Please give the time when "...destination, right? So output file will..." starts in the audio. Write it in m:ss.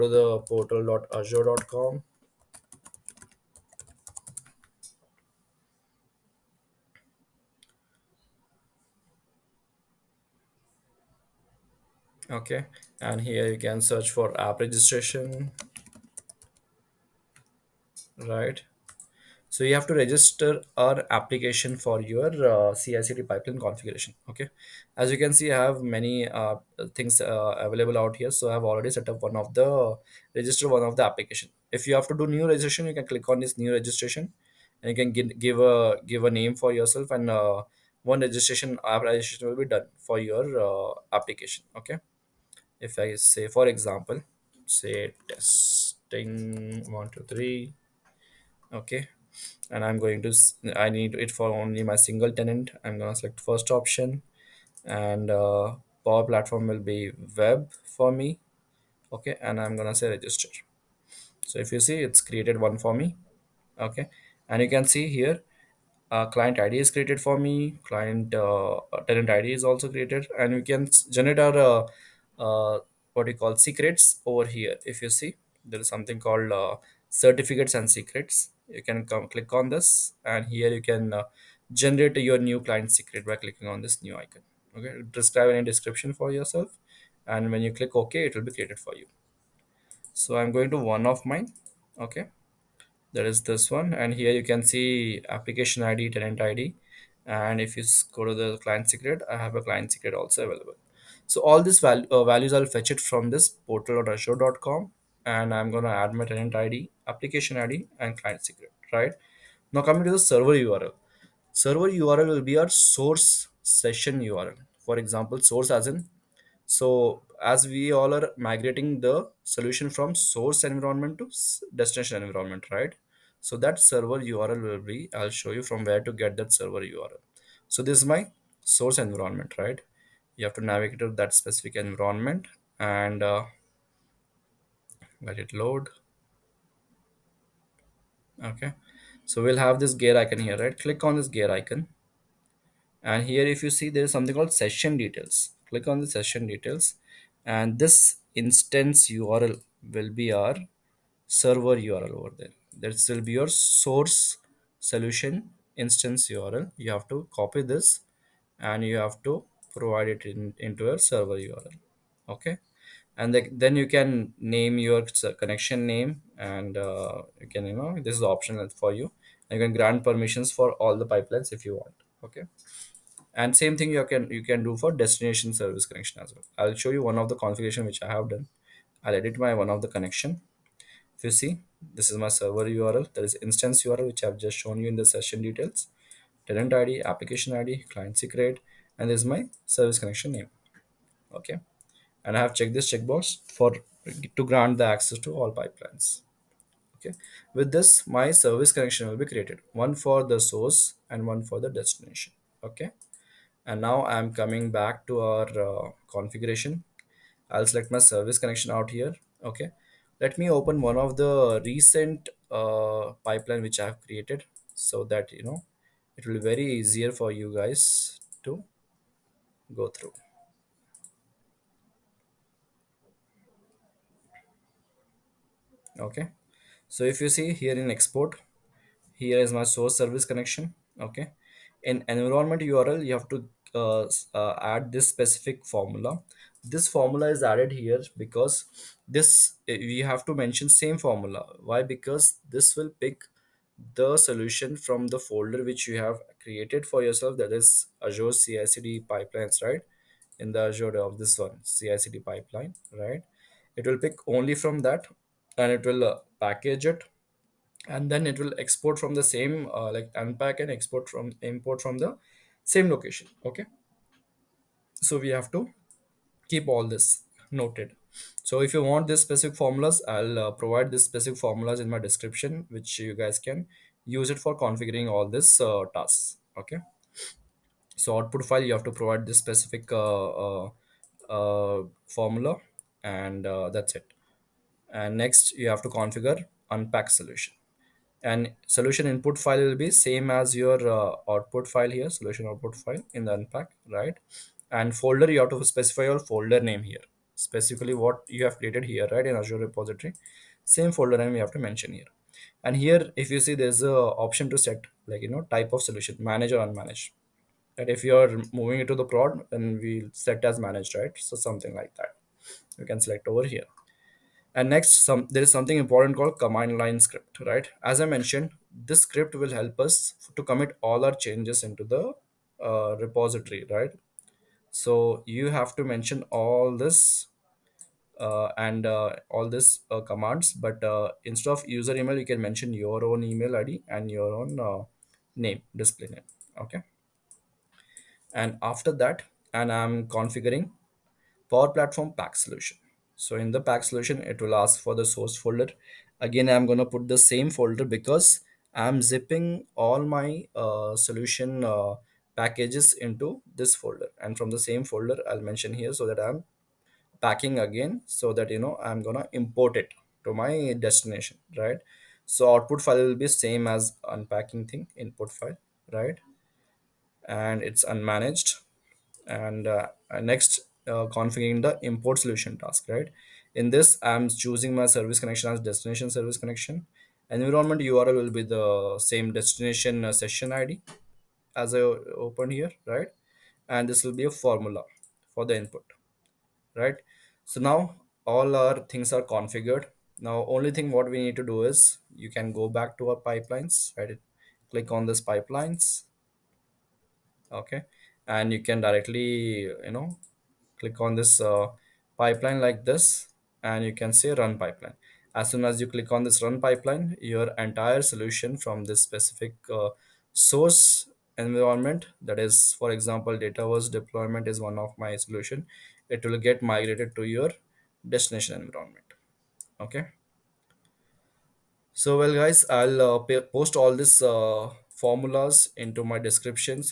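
6:00.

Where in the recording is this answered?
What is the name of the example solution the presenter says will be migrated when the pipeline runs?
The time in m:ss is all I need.
6:53.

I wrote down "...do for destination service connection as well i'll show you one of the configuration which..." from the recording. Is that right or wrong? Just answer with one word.
right.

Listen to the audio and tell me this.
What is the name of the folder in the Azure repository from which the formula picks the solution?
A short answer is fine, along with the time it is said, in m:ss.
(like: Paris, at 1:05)
azure cicd pipelines, at 4:08.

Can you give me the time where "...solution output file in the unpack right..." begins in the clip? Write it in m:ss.
4:52.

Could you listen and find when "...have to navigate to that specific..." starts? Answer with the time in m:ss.
2:10.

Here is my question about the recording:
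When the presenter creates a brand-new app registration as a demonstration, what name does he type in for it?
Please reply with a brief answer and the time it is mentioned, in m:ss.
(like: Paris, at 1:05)
testing 123, at 0:45.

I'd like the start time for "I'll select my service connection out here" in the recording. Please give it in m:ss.
3:27.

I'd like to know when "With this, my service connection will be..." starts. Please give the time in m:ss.
3:17.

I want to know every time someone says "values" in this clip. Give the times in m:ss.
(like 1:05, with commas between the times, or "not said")
1:42.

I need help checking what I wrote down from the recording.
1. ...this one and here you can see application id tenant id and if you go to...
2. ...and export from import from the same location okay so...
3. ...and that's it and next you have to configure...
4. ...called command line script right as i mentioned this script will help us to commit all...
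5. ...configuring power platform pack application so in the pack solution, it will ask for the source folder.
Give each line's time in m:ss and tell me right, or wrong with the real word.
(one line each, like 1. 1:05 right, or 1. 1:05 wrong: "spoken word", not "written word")
1. 1:33 right
2. 4:20 right
3. 4:43 right
4. 5:16 right
5. 5:40 wrong: "solution", not "application".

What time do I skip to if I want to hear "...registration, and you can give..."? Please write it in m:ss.
0:33.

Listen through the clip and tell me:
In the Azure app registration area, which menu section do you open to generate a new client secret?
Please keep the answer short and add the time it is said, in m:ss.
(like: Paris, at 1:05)
certificates and secrets, at 1:17.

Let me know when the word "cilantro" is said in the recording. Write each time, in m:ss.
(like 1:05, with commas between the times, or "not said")
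not said.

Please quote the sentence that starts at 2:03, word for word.
So that server URL will be, I'll show you from where to get that server URL.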